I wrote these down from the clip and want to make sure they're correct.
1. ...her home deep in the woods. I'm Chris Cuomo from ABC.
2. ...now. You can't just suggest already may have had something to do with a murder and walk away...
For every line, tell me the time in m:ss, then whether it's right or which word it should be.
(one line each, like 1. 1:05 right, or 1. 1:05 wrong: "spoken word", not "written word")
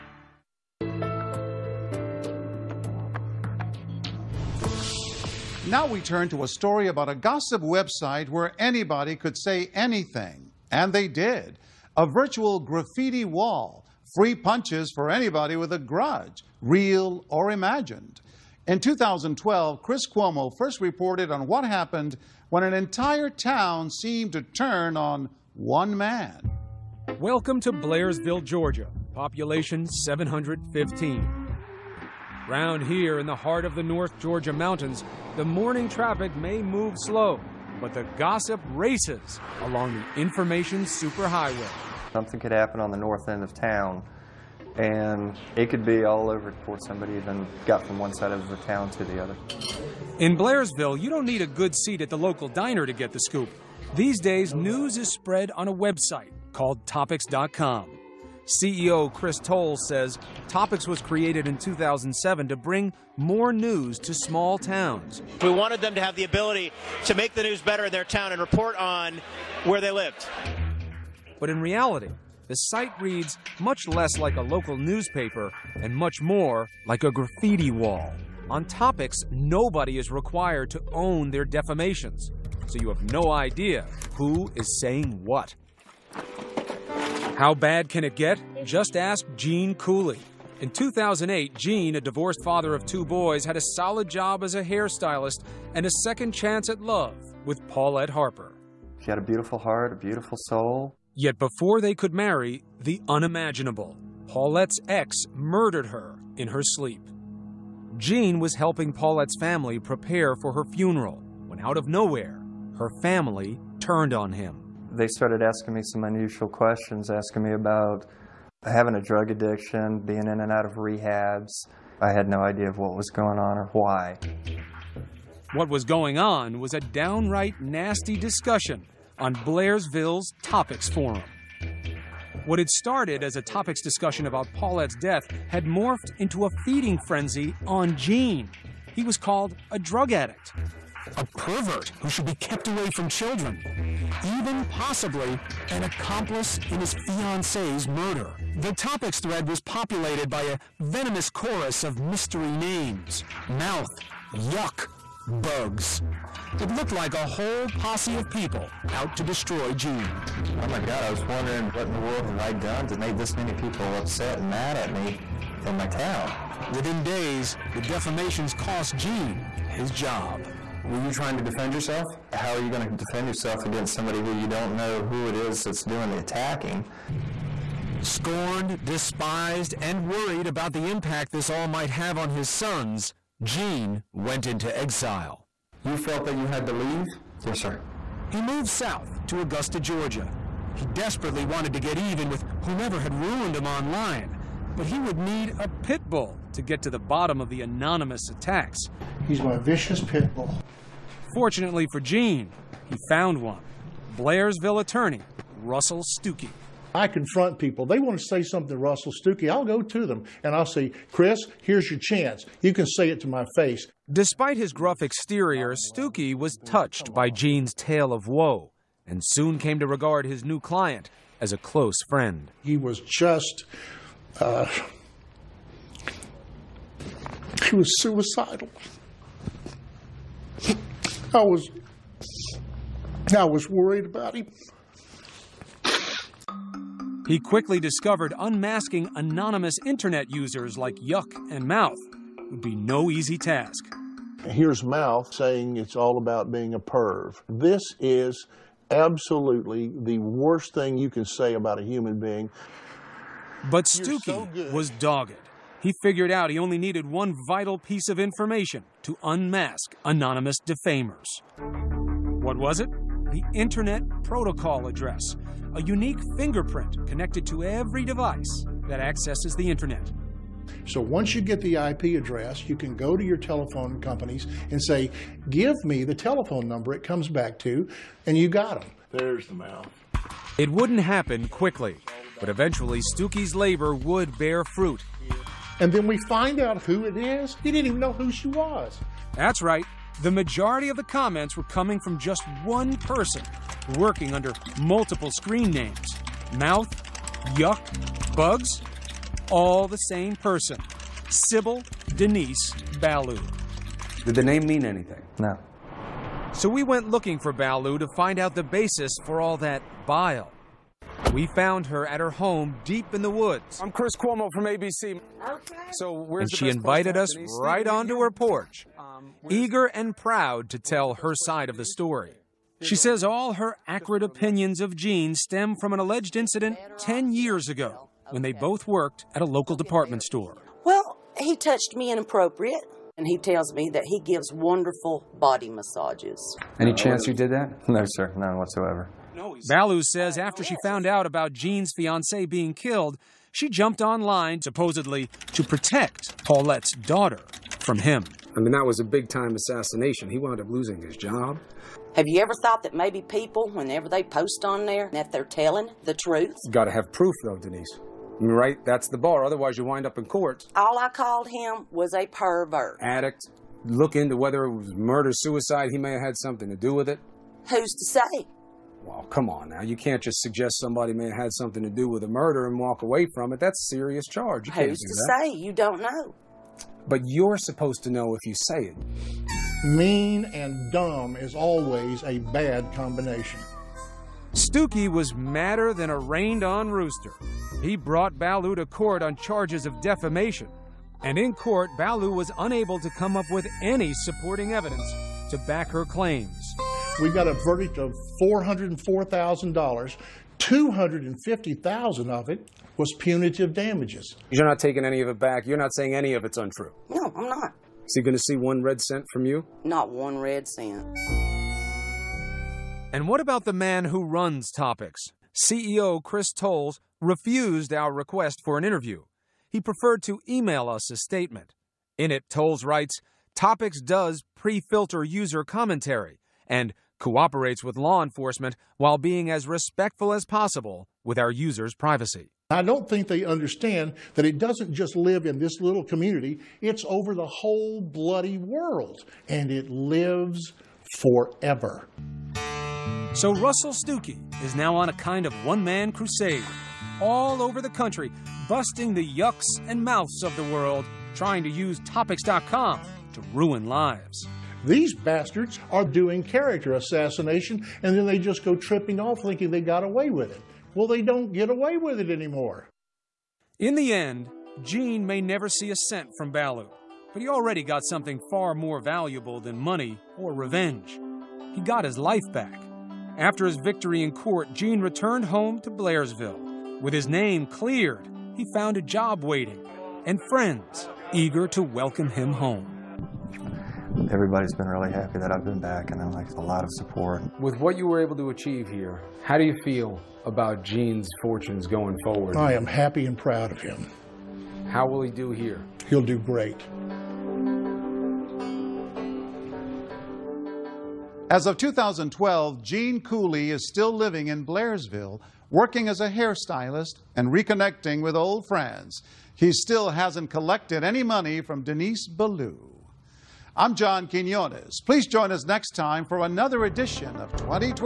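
1. 5:12 right
2. 6:09 wrong: "somebody", not "already".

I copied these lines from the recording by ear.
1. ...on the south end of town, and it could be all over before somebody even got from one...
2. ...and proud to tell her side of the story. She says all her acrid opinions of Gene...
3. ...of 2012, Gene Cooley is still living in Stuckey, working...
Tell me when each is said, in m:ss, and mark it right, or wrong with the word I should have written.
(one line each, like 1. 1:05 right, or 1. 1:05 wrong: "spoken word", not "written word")
1. 0:42 wrong: "north", not "south"
2. 5:19 right
3. 8:21 wrong: "Blairsville", not "Stuckey".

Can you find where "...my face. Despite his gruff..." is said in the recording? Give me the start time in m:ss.
3:33.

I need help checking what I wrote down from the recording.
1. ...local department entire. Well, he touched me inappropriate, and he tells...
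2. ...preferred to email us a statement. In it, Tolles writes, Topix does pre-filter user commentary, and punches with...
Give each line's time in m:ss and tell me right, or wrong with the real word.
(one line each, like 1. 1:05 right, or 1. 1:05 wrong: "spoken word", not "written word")
1. 5:29 wrong: "store", not "entire"
2. 6:59 wrong: "cooperates", not "punches".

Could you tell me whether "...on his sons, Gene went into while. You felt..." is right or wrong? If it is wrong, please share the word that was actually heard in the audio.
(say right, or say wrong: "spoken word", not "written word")
wrong: "exile", not "while".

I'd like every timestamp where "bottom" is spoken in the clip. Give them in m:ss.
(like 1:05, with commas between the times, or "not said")
3:16.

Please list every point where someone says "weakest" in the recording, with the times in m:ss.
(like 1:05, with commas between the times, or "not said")
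not said.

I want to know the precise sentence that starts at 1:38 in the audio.
She had a beautiful heart, a beautiful soul.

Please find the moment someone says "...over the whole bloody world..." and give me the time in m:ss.
7:17.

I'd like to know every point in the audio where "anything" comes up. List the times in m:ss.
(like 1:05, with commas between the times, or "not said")
0:09, 5:04.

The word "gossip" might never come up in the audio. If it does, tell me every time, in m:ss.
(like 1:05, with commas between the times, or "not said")
0:07, 0:38.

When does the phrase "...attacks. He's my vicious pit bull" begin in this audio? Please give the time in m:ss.
3:18.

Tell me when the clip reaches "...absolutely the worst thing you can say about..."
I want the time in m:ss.
4:08.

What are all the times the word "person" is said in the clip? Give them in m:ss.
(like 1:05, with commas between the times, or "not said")
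4:52, 5:00.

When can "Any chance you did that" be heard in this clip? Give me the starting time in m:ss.
5:36.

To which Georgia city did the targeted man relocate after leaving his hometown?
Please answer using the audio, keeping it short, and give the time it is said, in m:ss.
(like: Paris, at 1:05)
Augusta, at 3:09.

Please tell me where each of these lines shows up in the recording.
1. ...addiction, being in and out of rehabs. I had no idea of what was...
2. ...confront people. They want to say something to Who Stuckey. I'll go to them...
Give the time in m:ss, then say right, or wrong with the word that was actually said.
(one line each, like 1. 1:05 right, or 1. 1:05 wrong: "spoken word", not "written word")
1. 1:59 right
2. 3:27 wrong: "Russell", not "Who".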